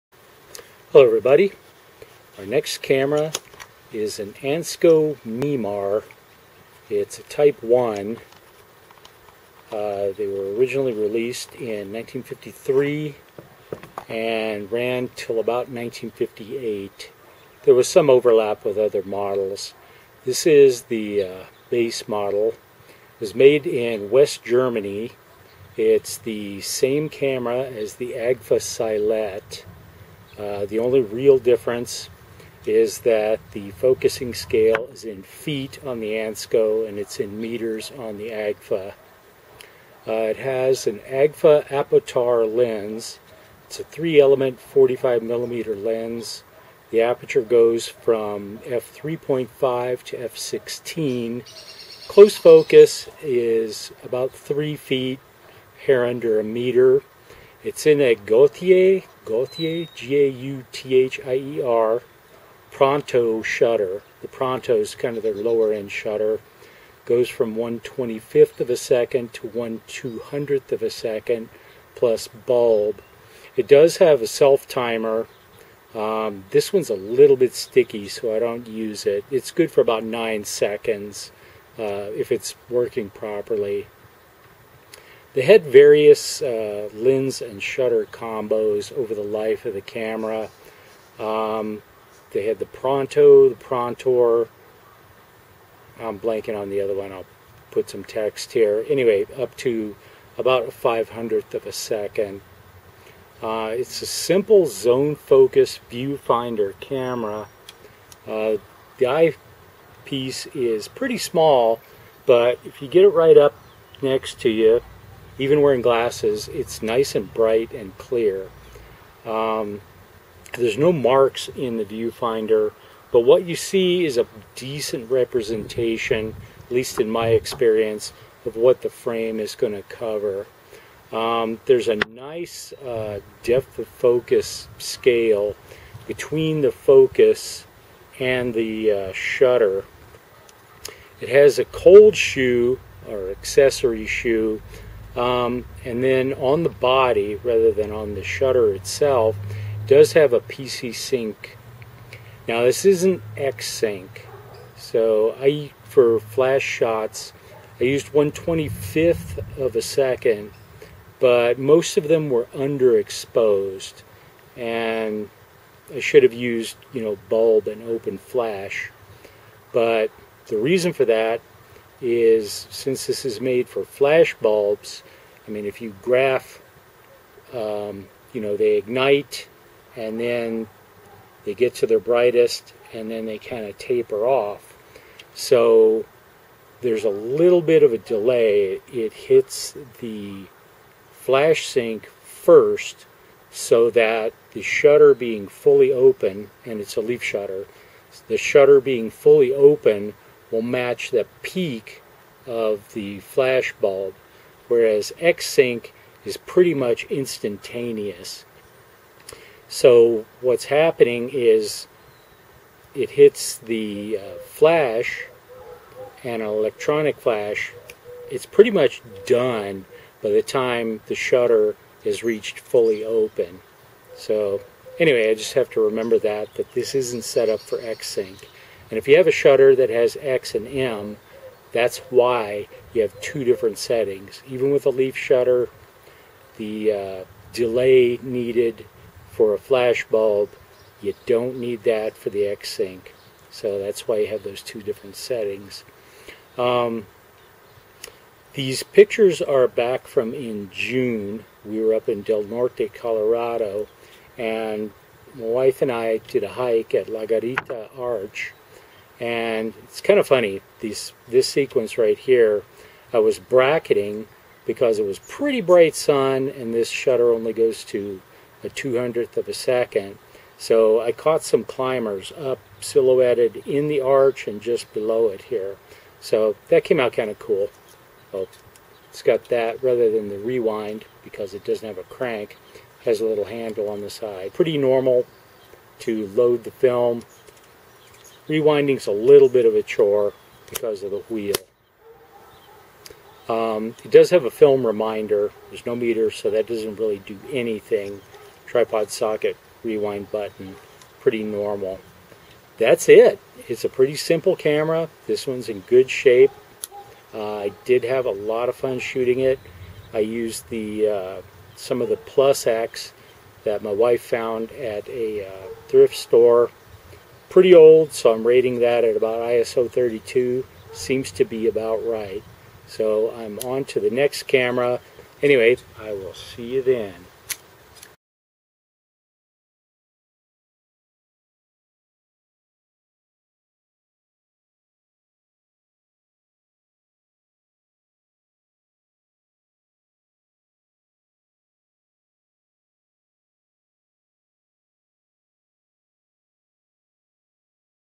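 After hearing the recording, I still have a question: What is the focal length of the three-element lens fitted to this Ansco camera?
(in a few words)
45 millimeter.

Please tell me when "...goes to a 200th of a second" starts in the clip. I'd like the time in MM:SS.
04:27.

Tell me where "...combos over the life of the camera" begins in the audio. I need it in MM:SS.
01:28.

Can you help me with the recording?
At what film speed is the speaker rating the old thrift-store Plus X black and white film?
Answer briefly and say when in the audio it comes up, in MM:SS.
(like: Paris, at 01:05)
ISO 32, at 05:19.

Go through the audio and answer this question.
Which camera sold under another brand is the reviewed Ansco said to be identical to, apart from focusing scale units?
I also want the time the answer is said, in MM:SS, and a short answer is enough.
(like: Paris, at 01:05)
Agfa Silette, at 00:28.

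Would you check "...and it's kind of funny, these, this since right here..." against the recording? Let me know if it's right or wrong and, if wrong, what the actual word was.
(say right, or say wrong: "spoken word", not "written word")
wrong: "sequence", not "since".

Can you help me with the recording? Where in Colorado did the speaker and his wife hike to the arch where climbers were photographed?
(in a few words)
Del Norte.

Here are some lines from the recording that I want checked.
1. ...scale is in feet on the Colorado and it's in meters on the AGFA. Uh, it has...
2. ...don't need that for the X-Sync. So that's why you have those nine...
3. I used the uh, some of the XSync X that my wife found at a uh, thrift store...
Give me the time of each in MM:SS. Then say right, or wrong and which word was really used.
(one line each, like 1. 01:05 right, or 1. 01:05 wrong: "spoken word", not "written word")
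1. 00:34 wrong: "ANSCO", not "Colorado"
2. 04:01 wrong: "two", not "nine"
3. 05:10 wrong: "Plus", not "XSync".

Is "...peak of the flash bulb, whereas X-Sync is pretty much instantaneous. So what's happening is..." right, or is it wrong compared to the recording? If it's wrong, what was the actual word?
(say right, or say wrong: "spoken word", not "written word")
right.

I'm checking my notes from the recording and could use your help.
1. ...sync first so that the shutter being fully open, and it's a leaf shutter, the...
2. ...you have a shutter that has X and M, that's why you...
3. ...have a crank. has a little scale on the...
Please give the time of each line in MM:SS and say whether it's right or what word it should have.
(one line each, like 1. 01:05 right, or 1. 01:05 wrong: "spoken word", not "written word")
1. 03:11 right
2. 03:49 right
3. 04:41 wrong: "handle", not "scale".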